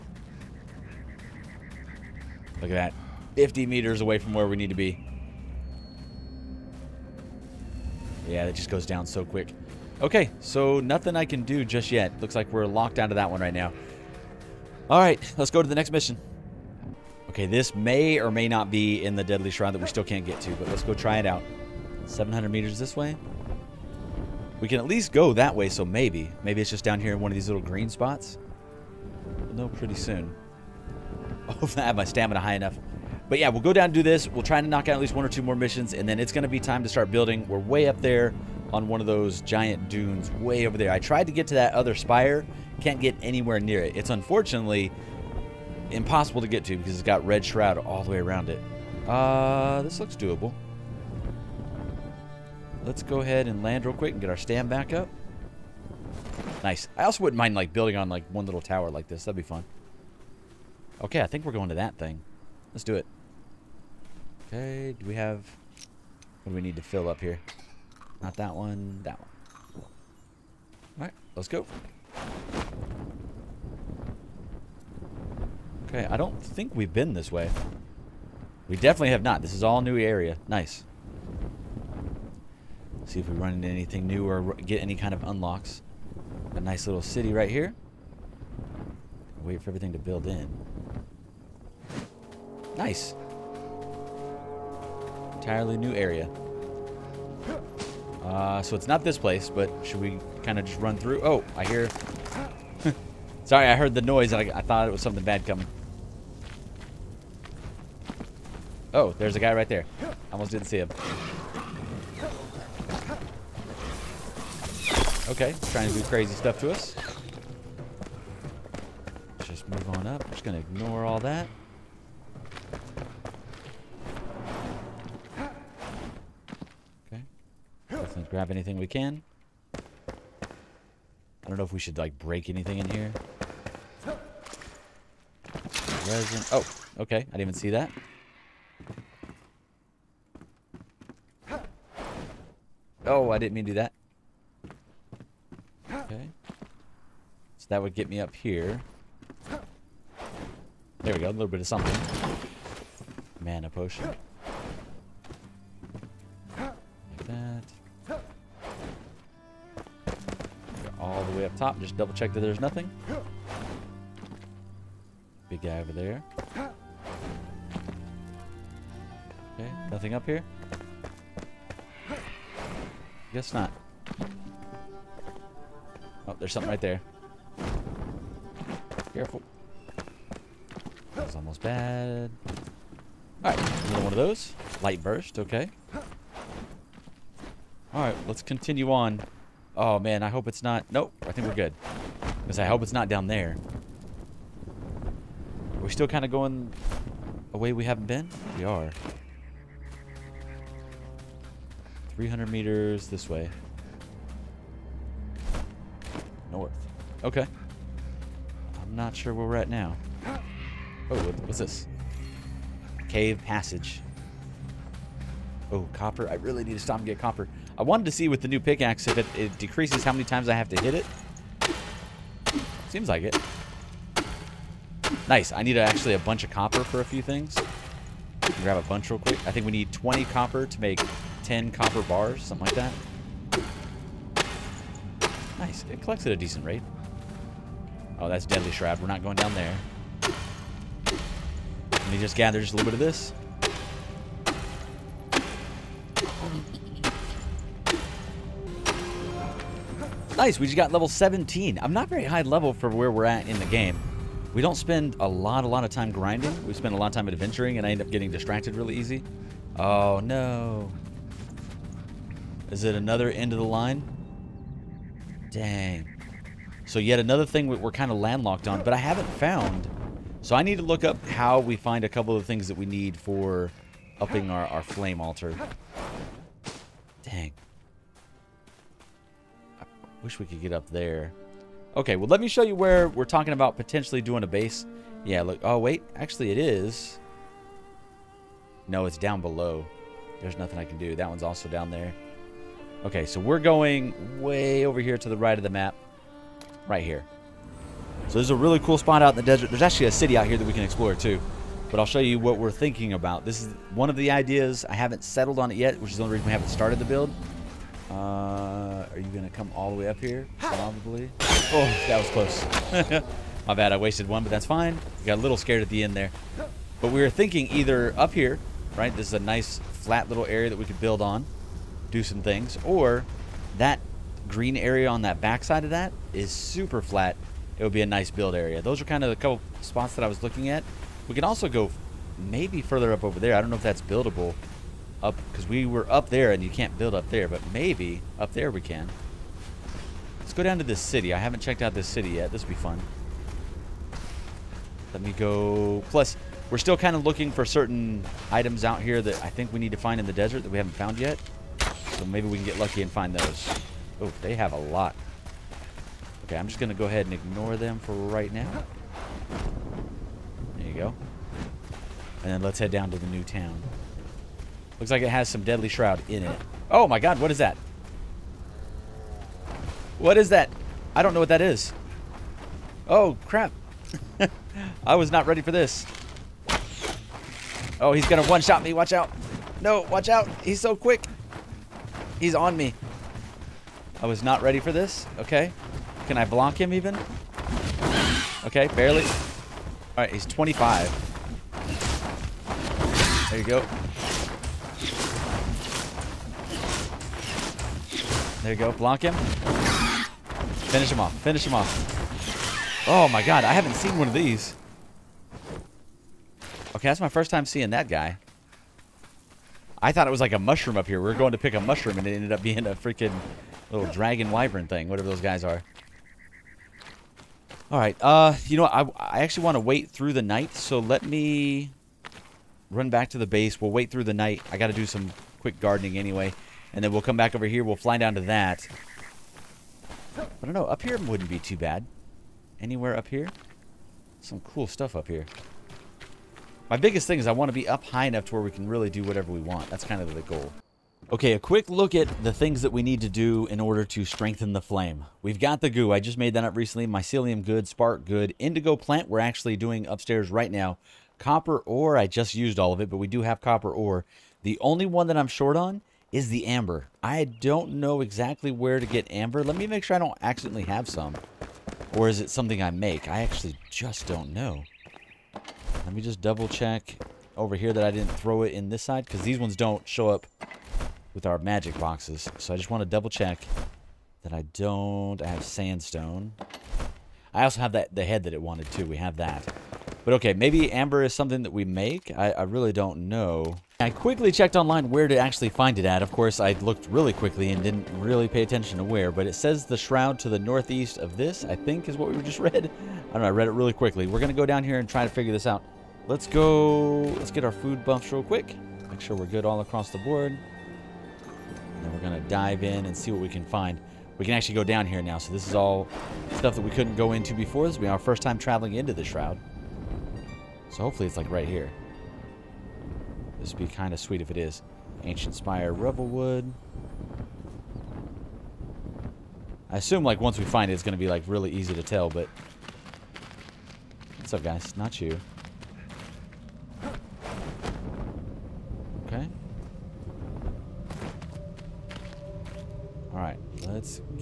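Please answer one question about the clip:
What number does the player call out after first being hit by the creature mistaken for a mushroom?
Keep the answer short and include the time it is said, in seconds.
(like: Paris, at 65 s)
25, at 390 s.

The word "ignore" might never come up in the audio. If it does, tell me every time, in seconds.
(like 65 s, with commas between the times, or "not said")
120 s, 357 s.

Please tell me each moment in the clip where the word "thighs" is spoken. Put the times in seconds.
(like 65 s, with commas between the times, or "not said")
not said.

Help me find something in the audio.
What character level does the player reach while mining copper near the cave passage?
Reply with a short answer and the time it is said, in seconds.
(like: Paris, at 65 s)
17, at 250 s.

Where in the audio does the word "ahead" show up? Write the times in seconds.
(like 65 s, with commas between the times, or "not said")
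53 s, 357 s.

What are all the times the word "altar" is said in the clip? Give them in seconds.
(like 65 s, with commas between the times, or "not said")
275 s.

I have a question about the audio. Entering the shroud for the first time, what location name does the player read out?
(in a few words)
Ancient Spire, Revelwood.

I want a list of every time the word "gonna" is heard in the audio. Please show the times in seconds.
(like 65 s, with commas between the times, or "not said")
356 s, 378 s.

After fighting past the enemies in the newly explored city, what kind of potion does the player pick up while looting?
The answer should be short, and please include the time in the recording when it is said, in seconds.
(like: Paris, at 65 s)
Mana potion, at 153 s.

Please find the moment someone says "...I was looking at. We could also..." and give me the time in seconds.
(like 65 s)
330 s.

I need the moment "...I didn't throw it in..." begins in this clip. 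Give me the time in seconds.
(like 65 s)
468 s.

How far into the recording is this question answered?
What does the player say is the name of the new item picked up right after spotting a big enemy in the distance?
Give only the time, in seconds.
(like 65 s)
184 s.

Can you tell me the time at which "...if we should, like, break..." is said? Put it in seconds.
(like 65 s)
131 s.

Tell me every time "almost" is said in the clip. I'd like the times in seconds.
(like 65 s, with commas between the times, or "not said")
110 s, 181 s.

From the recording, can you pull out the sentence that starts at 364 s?
Looks like it has some Deadly Shroud in it.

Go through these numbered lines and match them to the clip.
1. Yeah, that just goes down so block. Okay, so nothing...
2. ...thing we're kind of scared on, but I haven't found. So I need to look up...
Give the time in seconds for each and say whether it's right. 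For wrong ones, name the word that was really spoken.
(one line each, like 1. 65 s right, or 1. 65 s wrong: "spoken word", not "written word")
1. 8 s wrong: "quick", not "block"
2. 267 s wrong: "landlocked", not "scared".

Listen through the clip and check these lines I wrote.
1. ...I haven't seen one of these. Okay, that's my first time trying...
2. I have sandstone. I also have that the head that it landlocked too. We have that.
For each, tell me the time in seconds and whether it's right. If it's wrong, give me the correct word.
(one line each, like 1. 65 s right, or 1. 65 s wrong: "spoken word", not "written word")
1. 403 s wrong: "seeing", not "trying"
2. 475 s wrong: "wanted", not "landlocked".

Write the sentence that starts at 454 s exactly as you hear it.
The only one that I'm short on is the amber.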